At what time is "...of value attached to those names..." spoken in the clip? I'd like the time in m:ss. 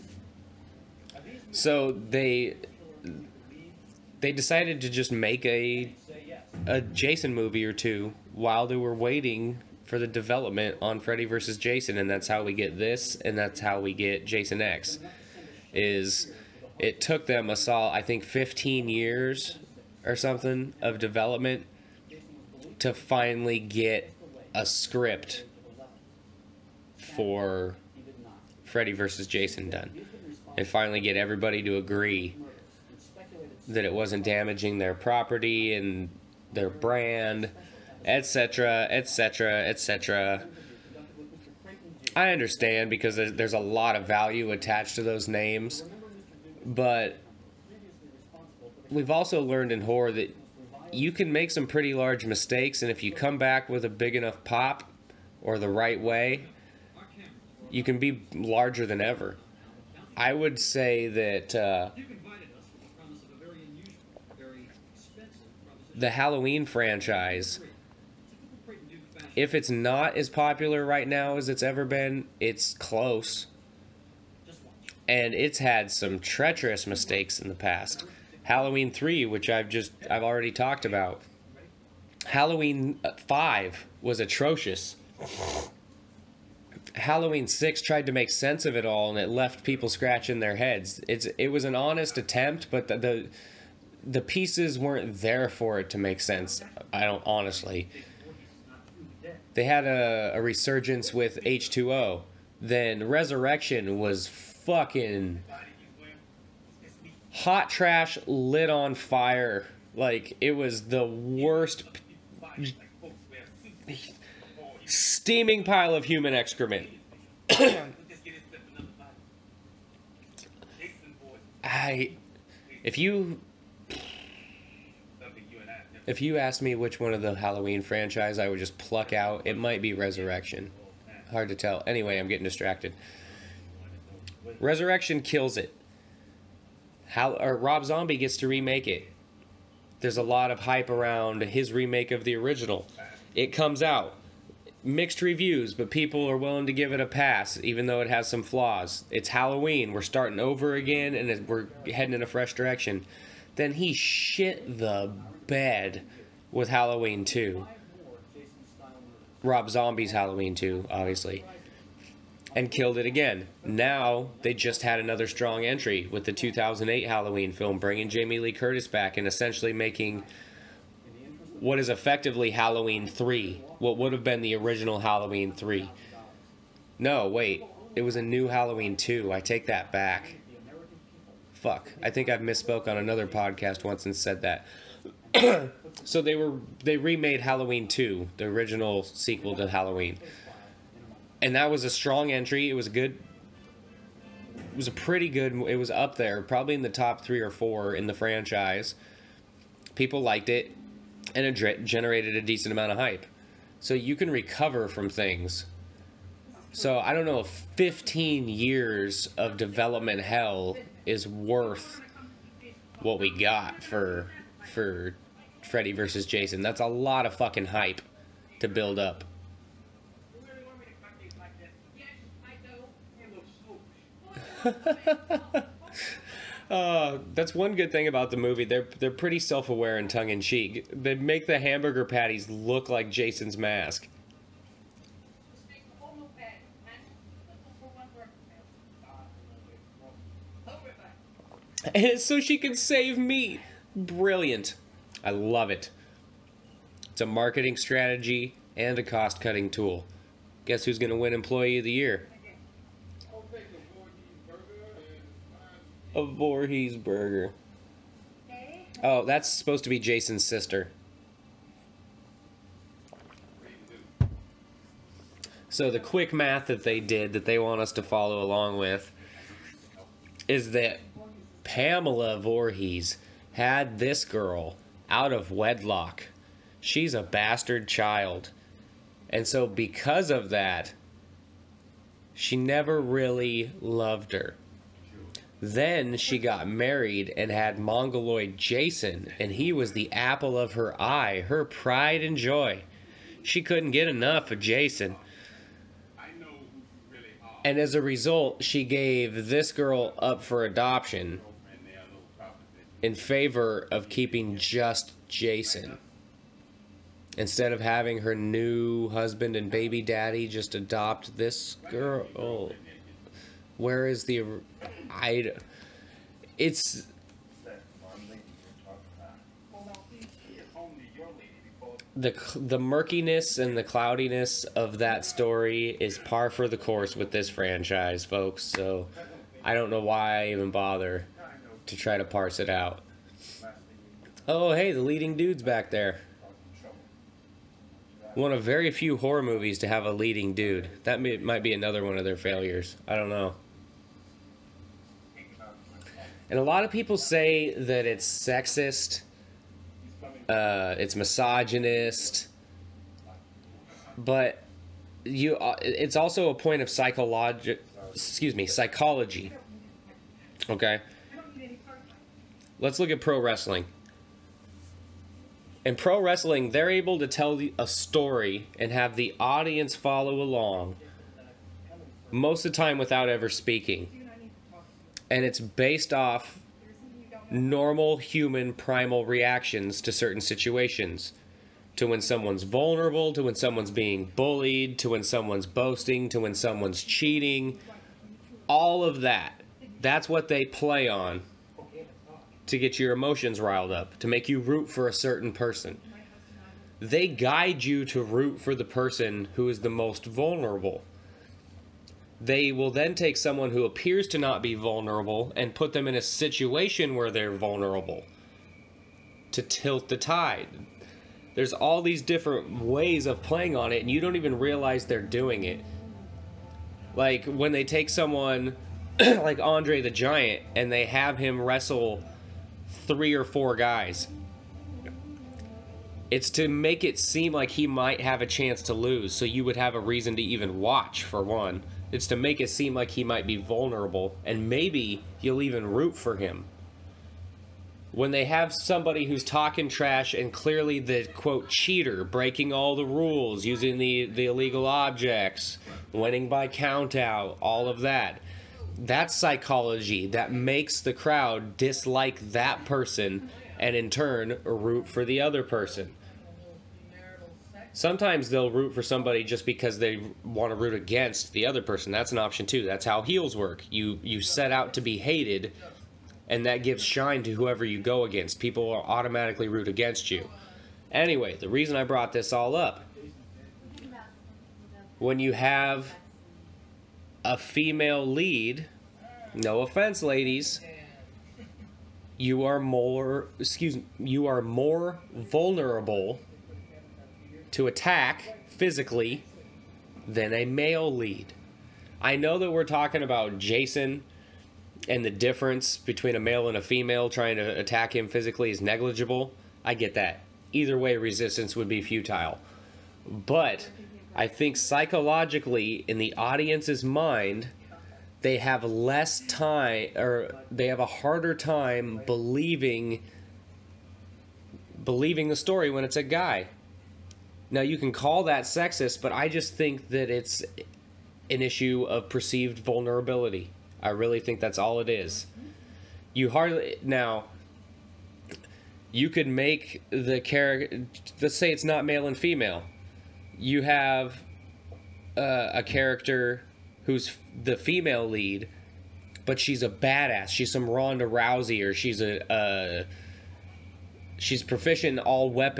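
0:43.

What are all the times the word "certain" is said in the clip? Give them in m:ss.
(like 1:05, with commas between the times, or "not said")
6:20, 6:35.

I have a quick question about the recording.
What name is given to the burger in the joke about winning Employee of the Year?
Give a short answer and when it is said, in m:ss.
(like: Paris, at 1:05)
Voorhees burger, at 4:16.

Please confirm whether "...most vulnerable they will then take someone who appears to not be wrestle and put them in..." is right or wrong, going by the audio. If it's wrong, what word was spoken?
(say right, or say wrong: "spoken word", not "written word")
wrong: "vulnerable", not "wrestle".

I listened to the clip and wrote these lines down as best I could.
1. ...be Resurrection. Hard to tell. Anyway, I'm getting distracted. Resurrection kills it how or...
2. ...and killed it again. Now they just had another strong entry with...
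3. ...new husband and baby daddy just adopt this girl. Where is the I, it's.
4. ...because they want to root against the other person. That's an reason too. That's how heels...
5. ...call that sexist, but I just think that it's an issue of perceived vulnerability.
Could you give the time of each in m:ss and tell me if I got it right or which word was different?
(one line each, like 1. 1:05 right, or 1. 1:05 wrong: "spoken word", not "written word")
1. 2:09 right
2. 2:42 right
3. 5:08 right
4. 7:39 wrong: "option", not "reason"
5. 8:38 right.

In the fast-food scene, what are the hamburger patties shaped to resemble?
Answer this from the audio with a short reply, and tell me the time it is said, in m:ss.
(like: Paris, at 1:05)
Jason's mask, at 3:53.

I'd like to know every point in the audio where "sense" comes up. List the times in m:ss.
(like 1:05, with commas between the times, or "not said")
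1:28, 1:36.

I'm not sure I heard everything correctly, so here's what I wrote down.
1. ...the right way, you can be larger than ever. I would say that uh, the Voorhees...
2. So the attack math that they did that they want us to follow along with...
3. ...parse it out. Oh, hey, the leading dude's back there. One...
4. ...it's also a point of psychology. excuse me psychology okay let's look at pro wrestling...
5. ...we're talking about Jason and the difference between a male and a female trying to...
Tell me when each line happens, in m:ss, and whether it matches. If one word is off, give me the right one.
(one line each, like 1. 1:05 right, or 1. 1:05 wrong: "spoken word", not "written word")
1. 0:55 wrong: "Halloween", not "Voorhees"
2. 4:25 wrong: "quick", not "attack"
3. 5:32 right
4. 5:55 right
5. 8:12 right.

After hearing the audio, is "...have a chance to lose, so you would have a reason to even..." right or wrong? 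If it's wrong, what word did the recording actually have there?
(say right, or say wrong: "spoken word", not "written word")
right.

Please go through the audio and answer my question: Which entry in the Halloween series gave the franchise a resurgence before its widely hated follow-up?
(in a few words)
H2O.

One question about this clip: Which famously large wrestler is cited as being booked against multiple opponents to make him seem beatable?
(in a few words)
Andre the Giant.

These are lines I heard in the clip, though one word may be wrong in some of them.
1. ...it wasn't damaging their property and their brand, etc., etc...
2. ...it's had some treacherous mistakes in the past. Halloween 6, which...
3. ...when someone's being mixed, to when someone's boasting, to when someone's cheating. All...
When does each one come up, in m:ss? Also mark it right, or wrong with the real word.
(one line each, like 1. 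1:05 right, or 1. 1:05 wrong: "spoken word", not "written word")
1. 0:33 right
2. 1:15 wrong: "3", not "6"
3. 6:23 wrong: "bullied", not "mixed".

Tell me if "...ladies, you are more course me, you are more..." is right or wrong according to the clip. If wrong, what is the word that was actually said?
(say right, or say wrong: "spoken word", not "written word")
wrong: "excuse", not "course".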